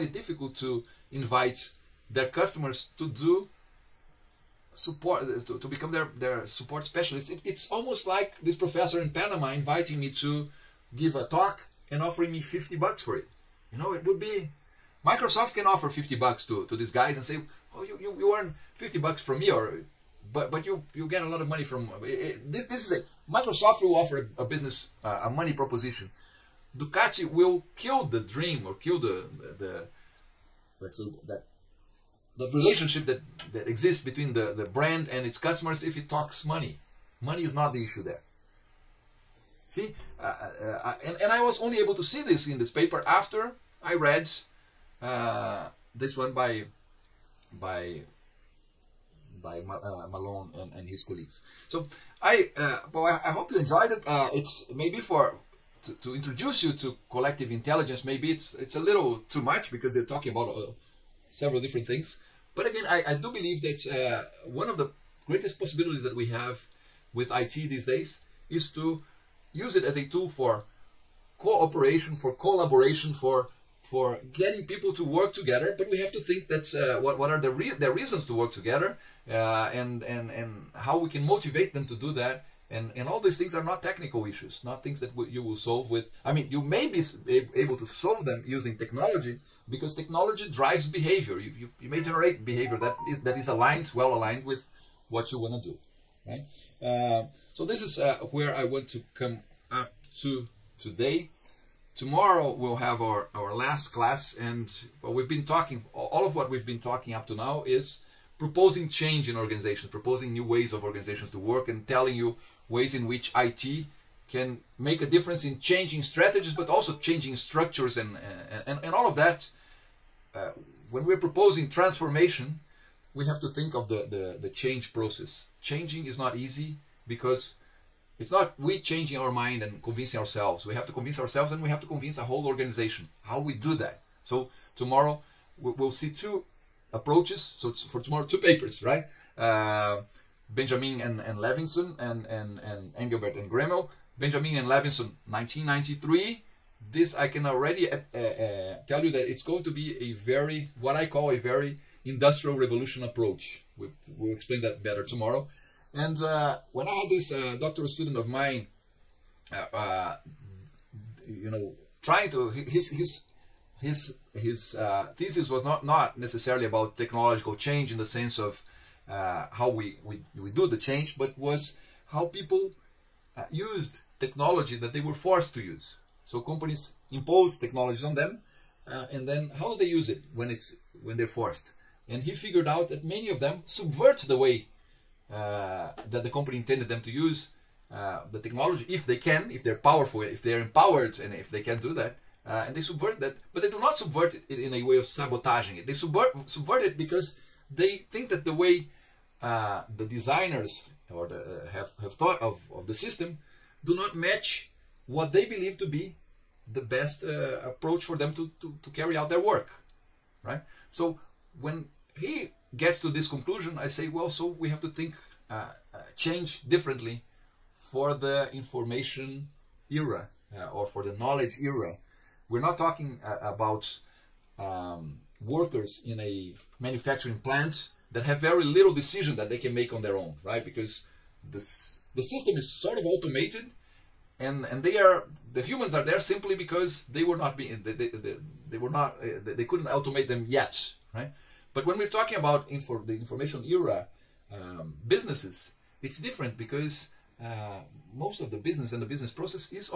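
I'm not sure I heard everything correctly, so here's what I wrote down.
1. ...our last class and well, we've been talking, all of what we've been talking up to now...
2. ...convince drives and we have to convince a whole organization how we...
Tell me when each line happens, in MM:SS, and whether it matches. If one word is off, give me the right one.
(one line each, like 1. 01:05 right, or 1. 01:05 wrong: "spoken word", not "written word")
1. 01:43 right
2. 02:10 wrong: "ourselves", not "drives".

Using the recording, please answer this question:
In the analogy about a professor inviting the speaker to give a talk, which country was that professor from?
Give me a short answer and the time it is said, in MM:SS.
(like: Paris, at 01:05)
Panama, at 00:09.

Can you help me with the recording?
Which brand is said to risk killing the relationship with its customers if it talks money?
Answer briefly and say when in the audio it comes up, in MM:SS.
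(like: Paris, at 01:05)
Ducati, at 00:26.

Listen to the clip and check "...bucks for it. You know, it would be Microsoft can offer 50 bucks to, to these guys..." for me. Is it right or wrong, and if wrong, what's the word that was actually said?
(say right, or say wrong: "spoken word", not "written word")
right.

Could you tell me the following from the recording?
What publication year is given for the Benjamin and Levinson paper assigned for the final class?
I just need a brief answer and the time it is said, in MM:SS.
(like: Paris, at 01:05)
1993, at 02:25.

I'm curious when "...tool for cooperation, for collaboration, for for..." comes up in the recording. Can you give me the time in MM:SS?
01:10.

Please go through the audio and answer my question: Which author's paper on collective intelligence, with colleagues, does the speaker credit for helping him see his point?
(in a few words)
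Malone.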